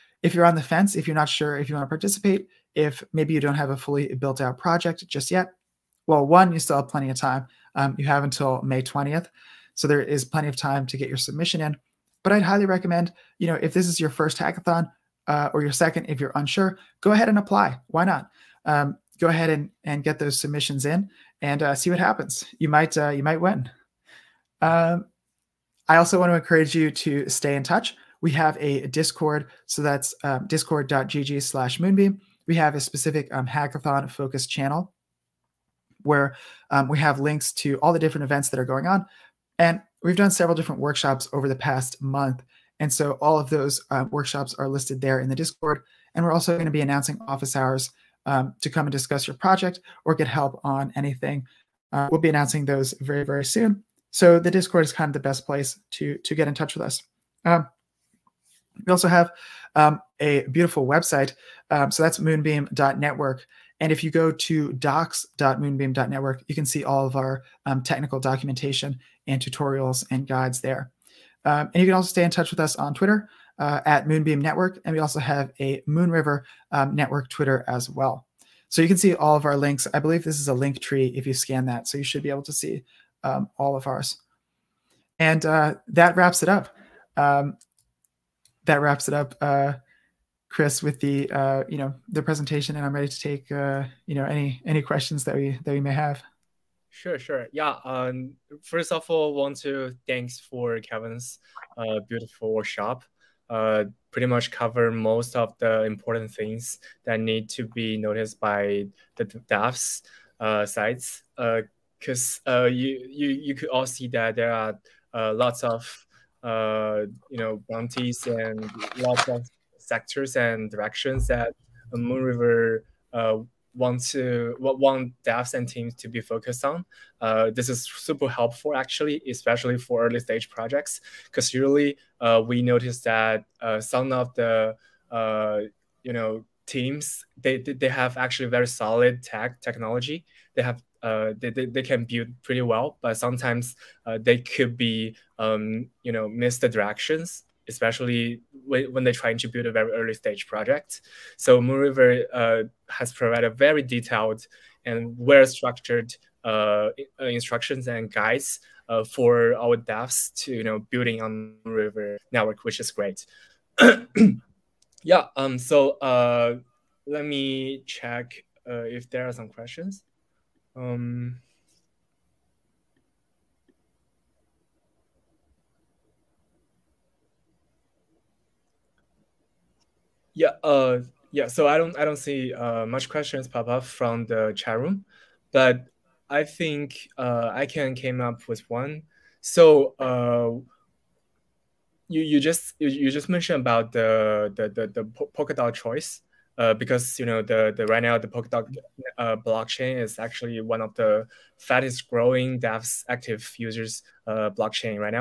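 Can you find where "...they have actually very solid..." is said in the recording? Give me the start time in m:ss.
2:17.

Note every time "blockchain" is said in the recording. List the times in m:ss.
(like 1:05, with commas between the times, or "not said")
3:19, 3:24.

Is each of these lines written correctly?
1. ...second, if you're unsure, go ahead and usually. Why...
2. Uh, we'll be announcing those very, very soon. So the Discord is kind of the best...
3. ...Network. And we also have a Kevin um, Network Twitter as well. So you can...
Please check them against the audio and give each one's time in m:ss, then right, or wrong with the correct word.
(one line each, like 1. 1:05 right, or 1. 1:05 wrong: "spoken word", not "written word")
1. 0:15 wrong: "apply", not "usually"
2. 0:51 right
3. 1:14 wrong: "Moonriver", not "Kevin".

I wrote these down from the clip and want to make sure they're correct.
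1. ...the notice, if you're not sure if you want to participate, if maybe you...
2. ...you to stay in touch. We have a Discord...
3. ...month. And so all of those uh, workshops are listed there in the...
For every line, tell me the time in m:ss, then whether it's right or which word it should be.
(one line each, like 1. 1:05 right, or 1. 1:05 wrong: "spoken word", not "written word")
1. 0:00 wrong: "fence", not "notice"
2. 0:26 right
3. 0:42 right.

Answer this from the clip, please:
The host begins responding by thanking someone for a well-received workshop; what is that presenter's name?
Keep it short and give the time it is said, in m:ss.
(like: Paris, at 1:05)
Kevin, at 1:40.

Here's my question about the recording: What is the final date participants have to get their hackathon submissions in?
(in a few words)
May 20th.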